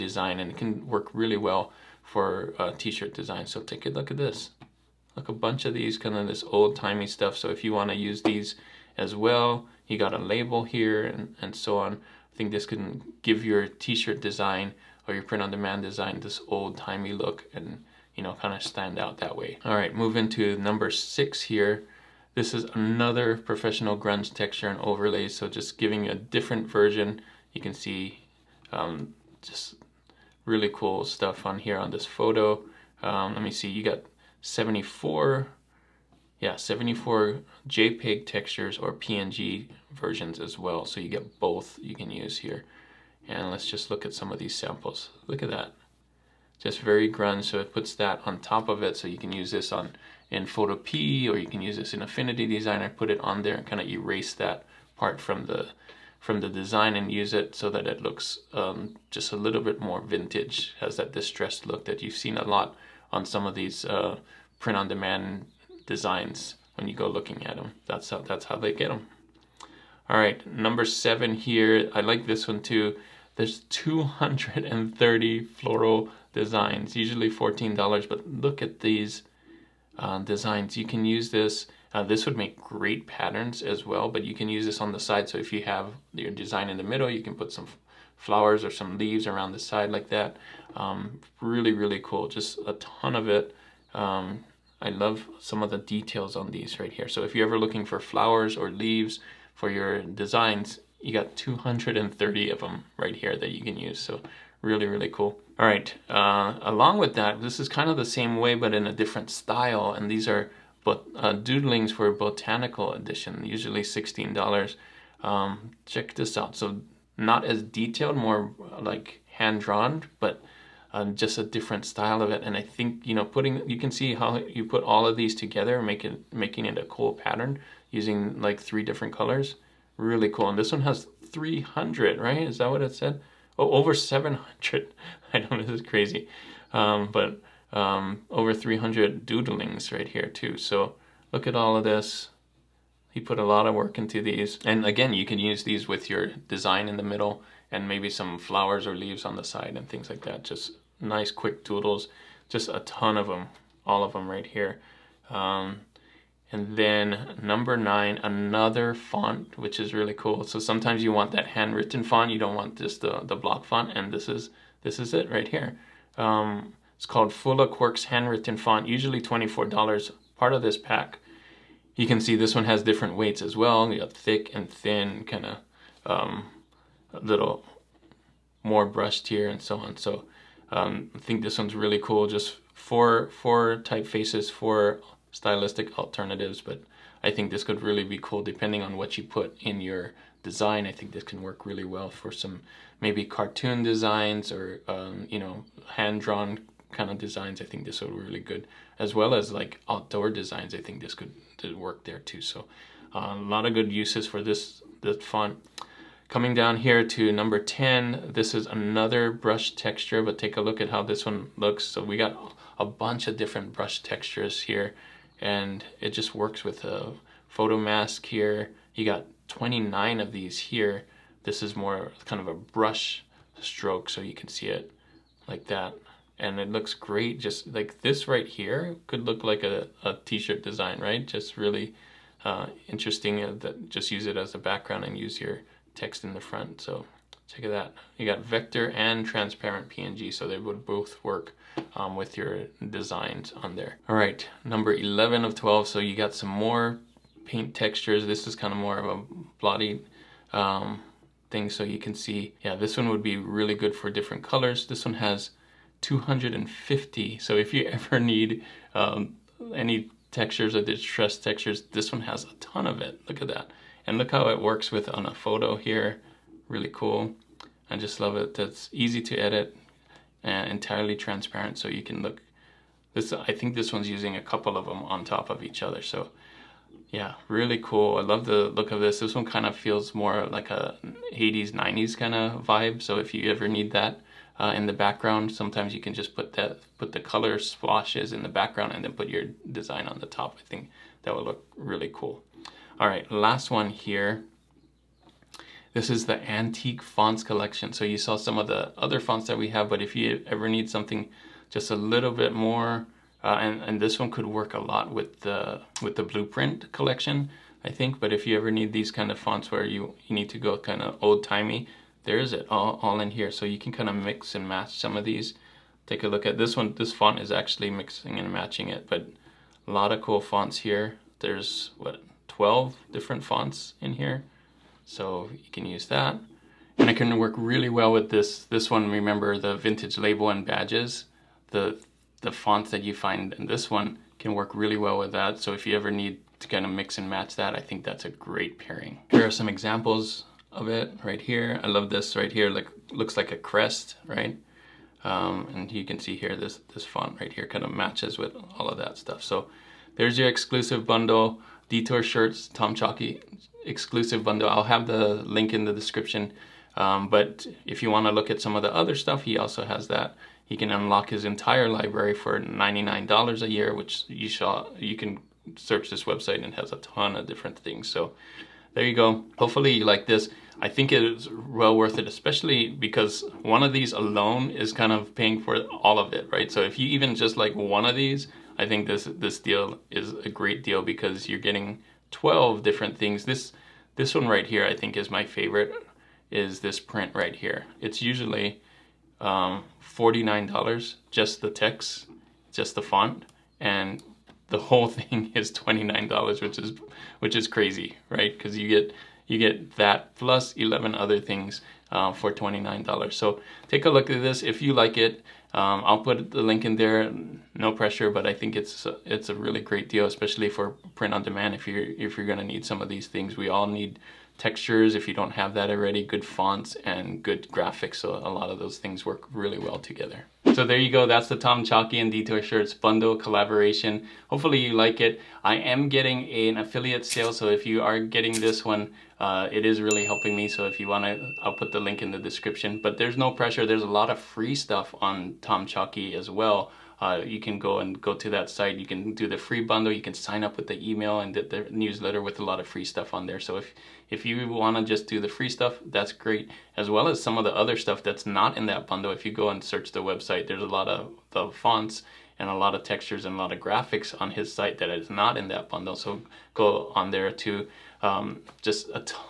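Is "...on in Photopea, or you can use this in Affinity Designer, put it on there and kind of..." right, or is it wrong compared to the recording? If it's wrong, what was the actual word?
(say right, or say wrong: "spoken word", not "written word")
right.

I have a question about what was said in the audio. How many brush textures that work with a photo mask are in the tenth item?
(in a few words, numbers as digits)
29.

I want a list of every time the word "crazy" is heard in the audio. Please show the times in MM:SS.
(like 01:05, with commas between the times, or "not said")
02:15, 06:37.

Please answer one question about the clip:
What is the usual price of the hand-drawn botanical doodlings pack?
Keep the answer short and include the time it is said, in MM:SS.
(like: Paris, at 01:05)
$16, at 01:53.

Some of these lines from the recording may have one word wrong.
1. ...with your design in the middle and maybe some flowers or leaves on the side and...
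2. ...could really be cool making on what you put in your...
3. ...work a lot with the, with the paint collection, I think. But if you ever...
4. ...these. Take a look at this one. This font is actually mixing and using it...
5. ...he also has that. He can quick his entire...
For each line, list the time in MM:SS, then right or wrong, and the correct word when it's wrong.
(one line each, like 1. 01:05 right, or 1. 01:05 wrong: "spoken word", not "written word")
1. 02:25 right
2. 03:07 wrong: "depending", not "making"
3. 05:04 wrong: "blueprint", not "paint"
4. 05:15 wrong: "matching", not "using"
5. 05:59 wrong: "unlock", not "quick".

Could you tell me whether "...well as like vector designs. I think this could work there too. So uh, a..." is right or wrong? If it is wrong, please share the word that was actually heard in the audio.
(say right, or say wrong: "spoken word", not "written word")
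wrong: "outdoor", not "vector".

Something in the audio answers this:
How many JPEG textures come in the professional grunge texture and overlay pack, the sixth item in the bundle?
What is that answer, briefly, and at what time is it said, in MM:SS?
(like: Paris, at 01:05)
74, at 00:36.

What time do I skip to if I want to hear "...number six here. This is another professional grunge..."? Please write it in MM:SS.
00:20.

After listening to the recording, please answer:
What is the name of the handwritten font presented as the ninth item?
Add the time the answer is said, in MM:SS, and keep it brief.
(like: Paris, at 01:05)
Fula Quirks, at 02:47.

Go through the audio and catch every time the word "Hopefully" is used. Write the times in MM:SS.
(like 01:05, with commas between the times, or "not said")
06:09, 07:04.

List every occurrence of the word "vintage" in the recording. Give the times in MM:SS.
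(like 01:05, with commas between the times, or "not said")
01:00, 05:29.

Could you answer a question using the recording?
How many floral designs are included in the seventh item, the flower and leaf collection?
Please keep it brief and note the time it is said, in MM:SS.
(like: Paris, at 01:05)
230, at 01:13.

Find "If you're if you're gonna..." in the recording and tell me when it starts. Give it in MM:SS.
06:51.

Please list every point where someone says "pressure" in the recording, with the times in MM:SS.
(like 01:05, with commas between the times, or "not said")
06:47, 07:13.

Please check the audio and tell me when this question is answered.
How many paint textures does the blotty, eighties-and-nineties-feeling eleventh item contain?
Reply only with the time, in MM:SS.
04:14.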